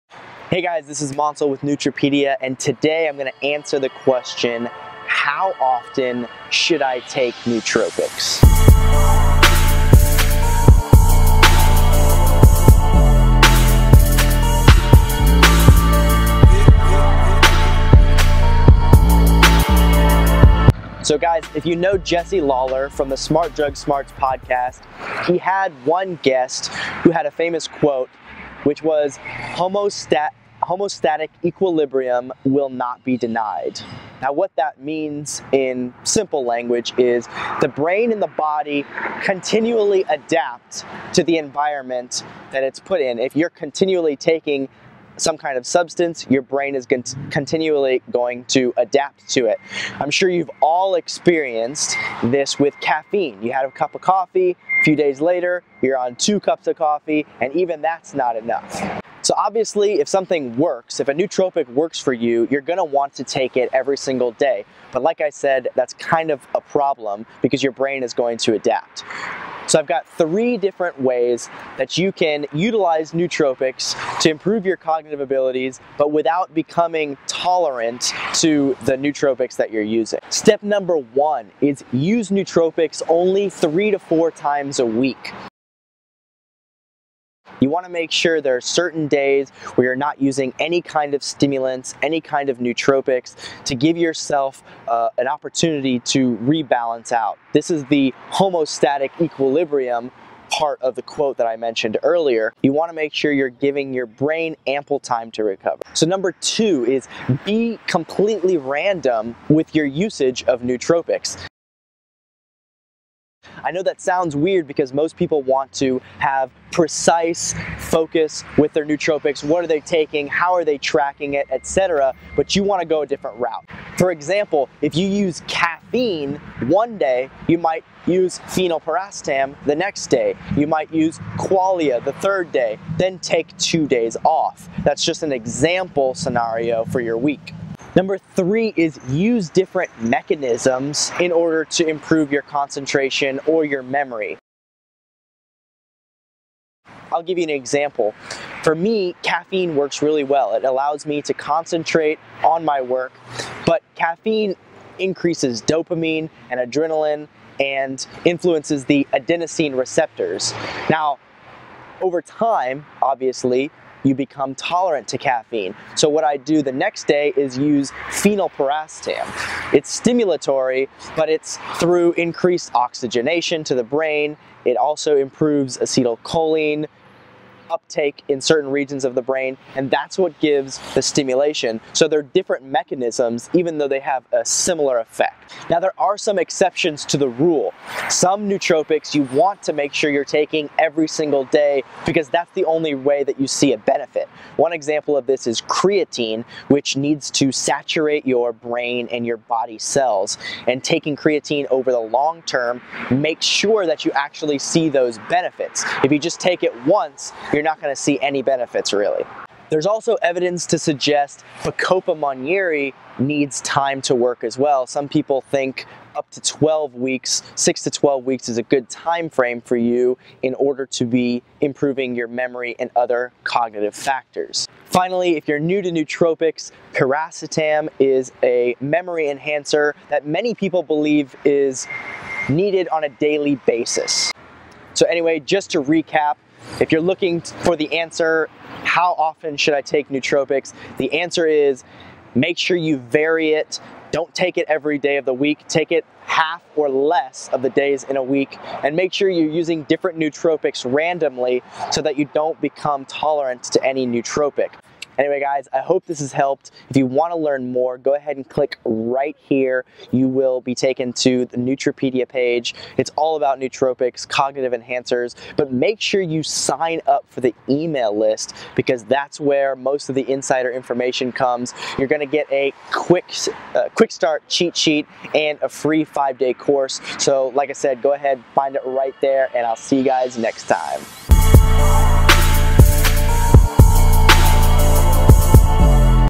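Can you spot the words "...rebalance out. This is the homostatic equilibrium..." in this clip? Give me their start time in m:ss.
1:36.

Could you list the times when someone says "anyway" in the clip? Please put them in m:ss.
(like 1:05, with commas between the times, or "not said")
3:55, 4:15.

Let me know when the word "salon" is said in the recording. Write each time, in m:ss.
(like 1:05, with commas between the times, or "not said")
not said.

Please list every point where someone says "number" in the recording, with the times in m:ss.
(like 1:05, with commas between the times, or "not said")
1:20, 1:46, 2:17.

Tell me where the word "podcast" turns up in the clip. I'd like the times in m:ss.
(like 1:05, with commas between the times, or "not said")
0:24.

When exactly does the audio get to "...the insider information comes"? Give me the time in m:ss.
4:30.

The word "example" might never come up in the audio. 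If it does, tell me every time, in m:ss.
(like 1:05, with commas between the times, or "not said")
2:04, 2:15, 2:27, 3:14.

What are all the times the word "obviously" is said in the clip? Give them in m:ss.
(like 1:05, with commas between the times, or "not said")
0:59, 2:43.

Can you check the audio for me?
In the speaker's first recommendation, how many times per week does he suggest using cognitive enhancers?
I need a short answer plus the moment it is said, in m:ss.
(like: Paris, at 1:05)
3 to 4, at 1:23.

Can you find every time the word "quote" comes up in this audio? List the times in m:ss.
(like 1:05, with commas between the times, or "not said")
0:27, 1:41.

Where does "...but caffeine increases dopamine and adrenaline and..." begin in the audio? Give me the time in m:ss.
2:33.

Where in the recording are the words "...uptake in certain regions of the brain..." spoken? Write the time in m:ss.
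2:57.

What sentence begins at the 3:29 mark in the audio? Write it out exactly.
There's also evidence to suggest Bacopa monnieri needs time to work as well.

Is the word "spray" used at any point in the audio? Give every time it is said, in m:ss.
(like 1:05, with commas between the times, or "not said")
not said.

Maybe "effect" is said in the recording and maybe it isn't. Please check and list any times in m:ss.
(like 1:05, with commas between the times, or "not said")
3:04.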